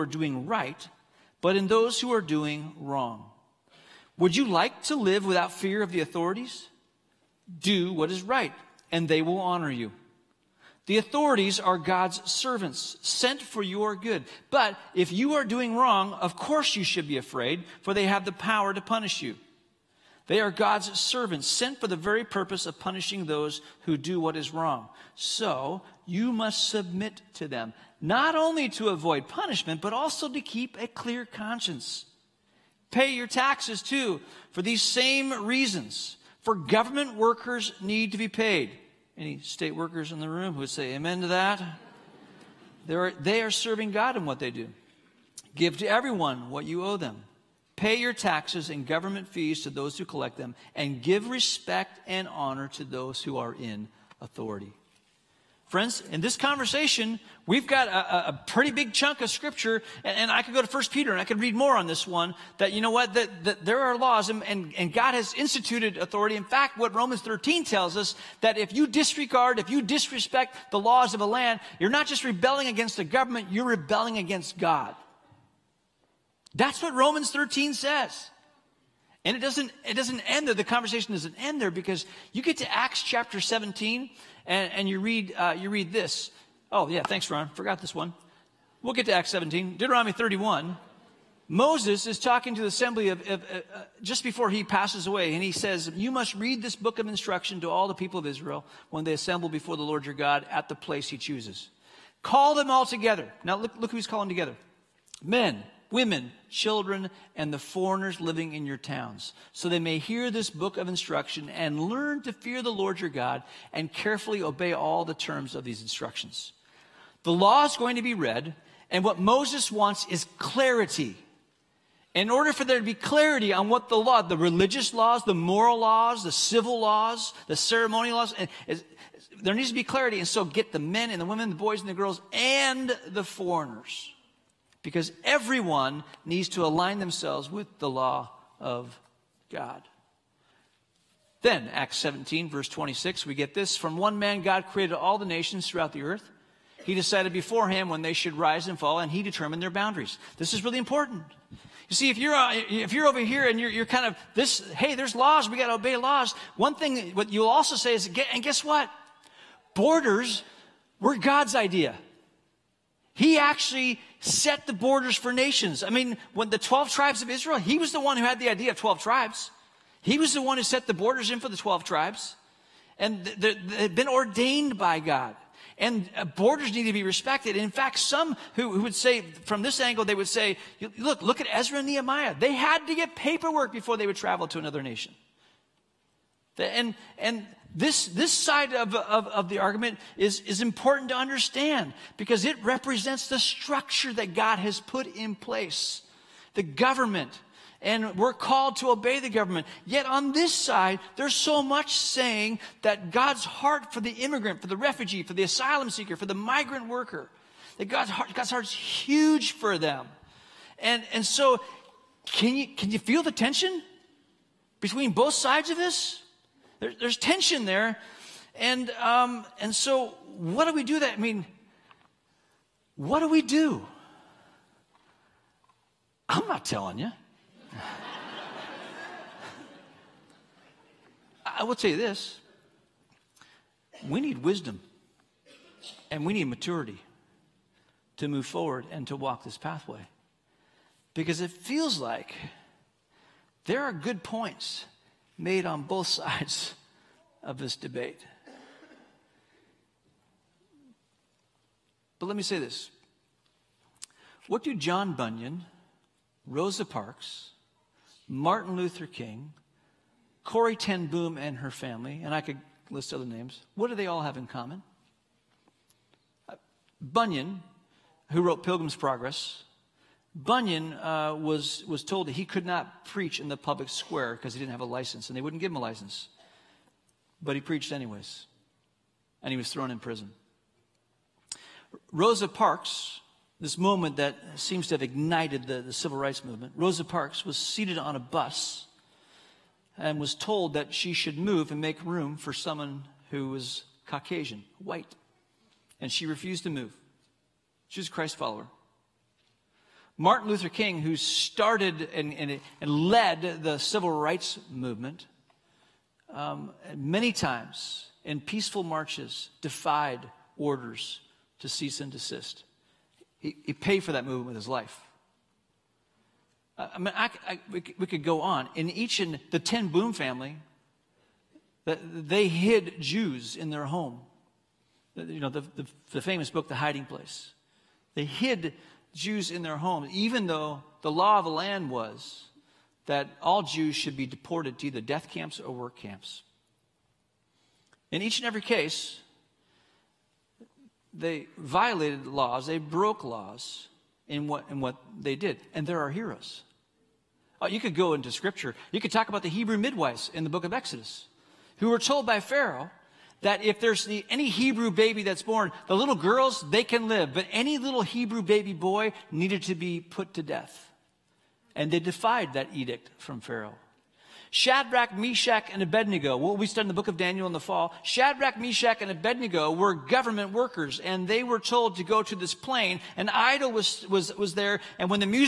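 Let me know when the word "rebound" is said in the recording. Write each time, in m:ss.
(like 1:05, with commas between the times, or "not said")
not said.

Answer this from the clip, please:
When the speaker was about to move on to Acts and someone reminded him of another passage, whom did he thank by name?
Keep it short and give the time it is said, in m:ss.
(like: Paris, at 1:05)
Ron, at 1:27.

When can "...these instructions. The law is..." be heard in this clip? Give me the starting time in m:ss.
1:55.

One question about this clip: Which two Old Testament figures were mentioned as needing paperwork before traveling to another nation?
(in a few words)
Ezra and Nehemiah.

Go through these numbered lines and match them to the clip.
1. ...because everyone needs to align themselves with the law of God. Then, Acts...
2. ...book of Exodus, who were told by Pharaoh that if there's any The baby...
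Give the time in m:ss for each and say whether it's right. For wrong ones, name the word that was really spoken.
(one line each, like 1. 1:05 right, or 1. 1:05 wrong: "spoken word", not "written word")
1. 2:14 right
2. 5:50 wrong: "Hebrew", not "The".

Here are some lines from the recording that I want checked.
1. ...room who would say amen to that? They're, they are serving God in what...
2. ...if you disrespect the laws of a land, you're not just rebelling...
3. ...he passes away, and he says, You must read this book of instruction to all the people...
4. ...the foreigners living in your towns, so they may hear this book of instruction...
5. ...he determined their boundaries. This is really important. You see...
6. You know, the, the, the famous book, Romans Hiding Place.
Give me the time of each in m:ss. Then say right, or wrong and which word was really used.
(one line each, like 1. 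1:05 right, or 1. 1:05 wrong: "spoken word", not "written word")
1. 0:40 right
2. 1:09 right
3. 1:34 right
4. 1:47 right
5. 2:29 right
6. 5:25 wrong: "The", not "Romans".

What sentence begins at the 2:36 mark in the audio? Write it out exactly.
One thing, what you'll also say is, and guess what?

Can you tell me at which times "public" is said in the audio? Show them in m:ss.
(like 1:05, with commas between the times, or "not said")
4:33.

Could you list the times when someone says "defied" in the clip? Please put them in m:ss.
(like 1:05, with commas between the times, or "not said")
5:09, 6:01.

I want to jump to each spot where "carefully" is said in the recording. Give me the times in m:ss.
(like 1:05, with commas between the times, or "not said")
1:53.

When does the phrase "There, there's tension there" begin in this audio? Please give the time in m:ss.
3:36.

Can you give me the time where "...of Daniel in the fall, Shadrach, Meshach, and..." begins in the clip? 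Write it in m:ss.
6:07.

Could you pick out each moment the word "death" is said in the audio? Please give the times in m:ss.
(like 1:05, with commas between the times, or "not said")
5:34, 6:00.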